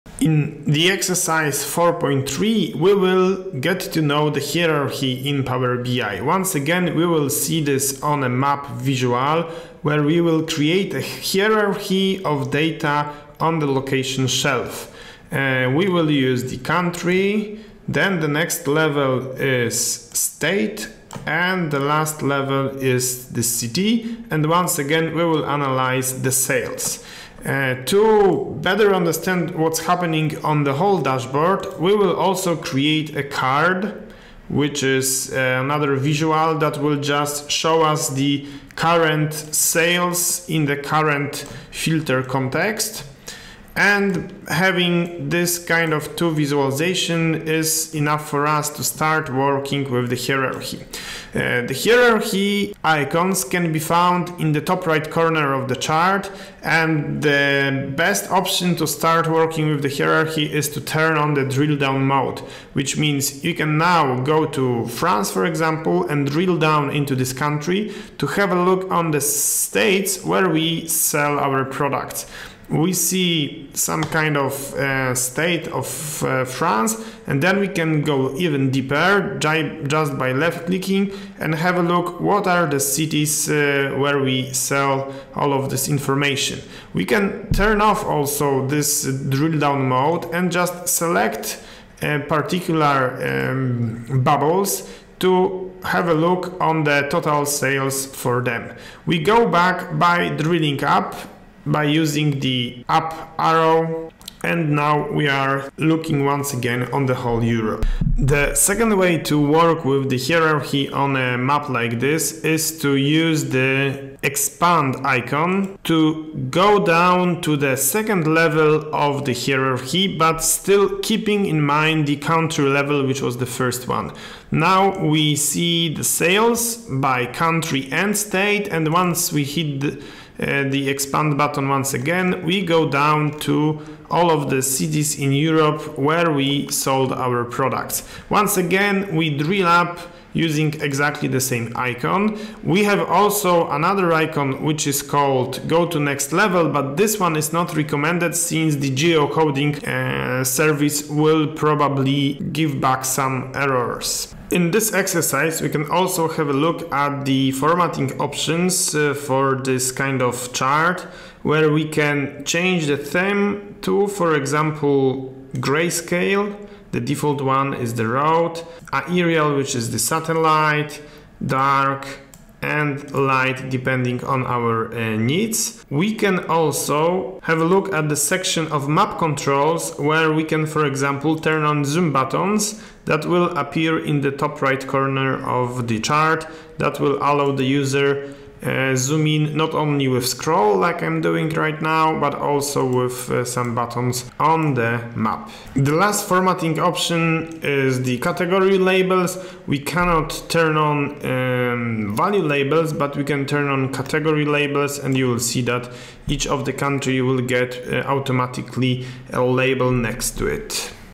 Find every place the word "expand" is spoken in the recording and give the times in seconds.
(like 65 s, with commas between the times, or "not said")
114 s, 130 s.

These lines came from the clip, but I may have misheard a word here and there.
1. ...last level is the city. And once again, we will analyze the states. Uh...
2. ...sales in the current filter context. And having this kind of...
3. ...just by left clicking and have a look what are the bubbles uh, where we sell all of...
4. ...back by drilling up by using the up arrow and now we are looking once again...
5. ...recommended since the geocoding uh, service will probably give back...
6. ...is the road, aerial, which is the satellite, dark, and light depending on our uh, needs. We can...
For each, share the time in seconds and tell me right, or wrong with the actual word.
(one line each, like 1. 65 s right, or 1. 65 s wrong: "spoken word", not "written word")
1. 21 s wrong: "sales", not "states"
2. 39 s right
3. 79 s wrong: "cities", not "bubbles"
4. 99 s right
5. 147 s right
6. 167 s right.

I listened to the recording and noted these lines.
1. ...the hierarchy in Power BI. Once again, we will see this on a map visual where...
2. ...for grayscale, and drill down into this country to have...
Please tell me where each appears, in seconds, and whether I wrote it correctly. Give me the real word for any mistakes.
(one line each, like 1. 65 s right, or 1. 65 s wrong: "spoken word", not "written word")
1. 4 s right
2. 65 s wrong: "example", not "grayscale".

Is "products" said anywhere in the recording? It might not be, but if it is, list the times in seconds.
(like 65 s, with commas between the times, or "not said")
71 s, 137 s.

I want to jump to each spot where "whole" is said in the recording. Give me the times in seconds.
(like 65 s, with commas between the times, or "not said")
30 s, 107 s.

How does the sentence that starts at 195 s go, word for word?
The last formatting option is the category labels.